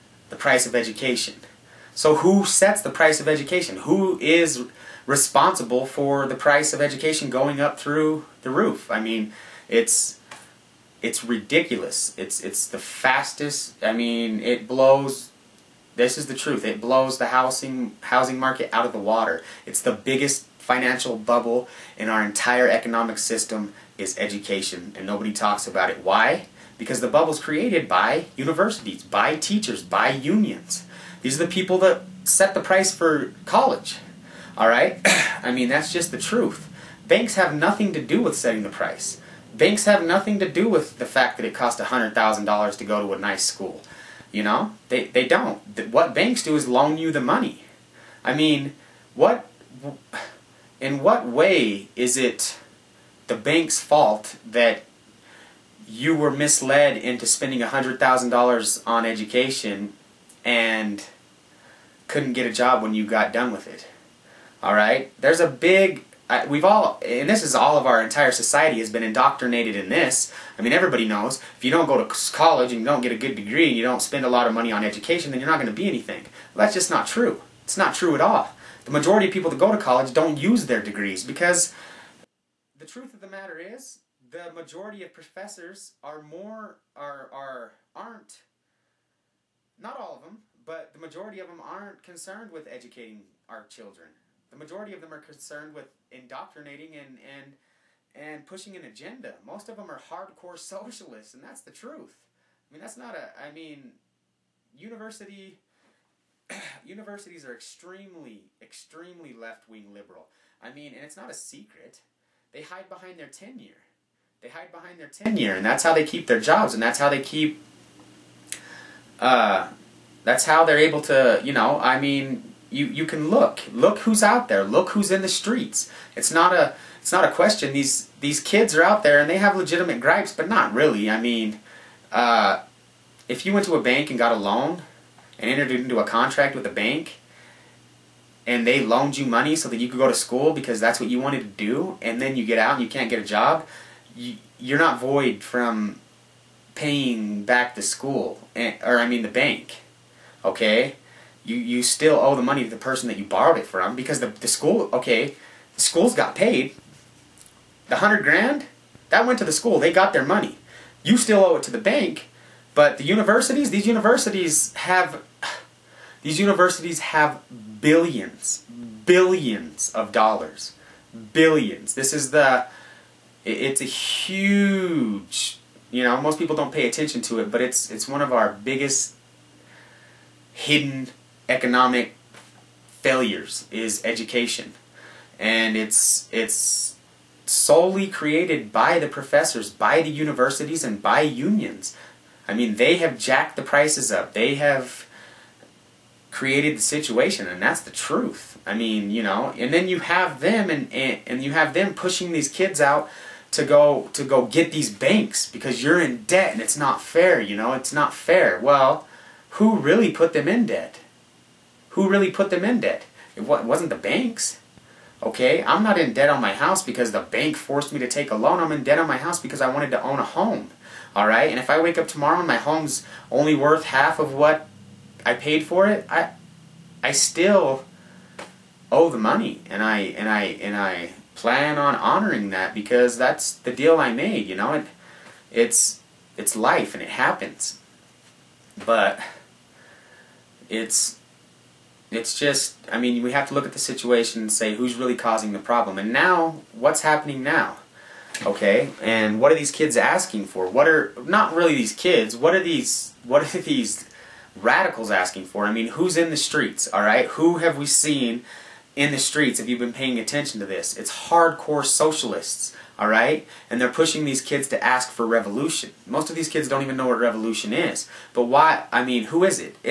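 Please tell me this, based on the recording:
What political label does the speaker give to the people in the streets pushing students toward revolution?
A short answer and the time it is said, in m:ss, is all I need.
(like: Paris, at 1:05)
hardcore socialists, at 4:21.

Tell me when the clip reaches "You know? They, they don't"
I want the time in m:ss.
0:44.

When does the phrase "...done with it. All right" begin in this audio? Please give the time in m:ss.
1:03.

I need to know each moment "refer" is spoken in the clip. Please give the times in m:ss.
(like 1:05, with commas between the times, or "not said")
not said.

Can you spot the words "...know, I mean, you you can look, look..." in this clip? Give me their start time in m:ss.
2:01.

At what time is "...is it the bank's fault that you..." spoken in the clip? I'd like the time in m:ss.
0:51.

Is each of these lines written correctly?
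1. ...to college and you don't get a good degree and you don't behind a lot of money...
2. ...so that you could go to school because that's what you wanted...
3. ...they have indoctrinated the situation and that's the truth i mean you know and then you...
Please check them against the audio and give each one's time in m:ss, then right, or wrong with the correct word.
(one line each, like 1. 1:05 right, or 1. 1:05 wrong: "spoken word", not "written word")
1. 1:12 wrong: "spend", not "behind"
2. 2:19 right
3. 3:14 wrong: "created", not "indoctrinated".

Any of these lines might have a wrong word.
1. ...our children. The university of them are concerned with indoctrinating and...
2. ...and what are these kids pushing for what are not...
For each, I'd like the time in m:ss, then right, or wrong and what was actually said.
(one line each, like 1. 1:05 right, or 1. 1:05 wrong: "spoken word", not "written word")
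1. 1:33 wrong: "majority", not "university"
2. 4:09 wrong: "asking", not "pushing".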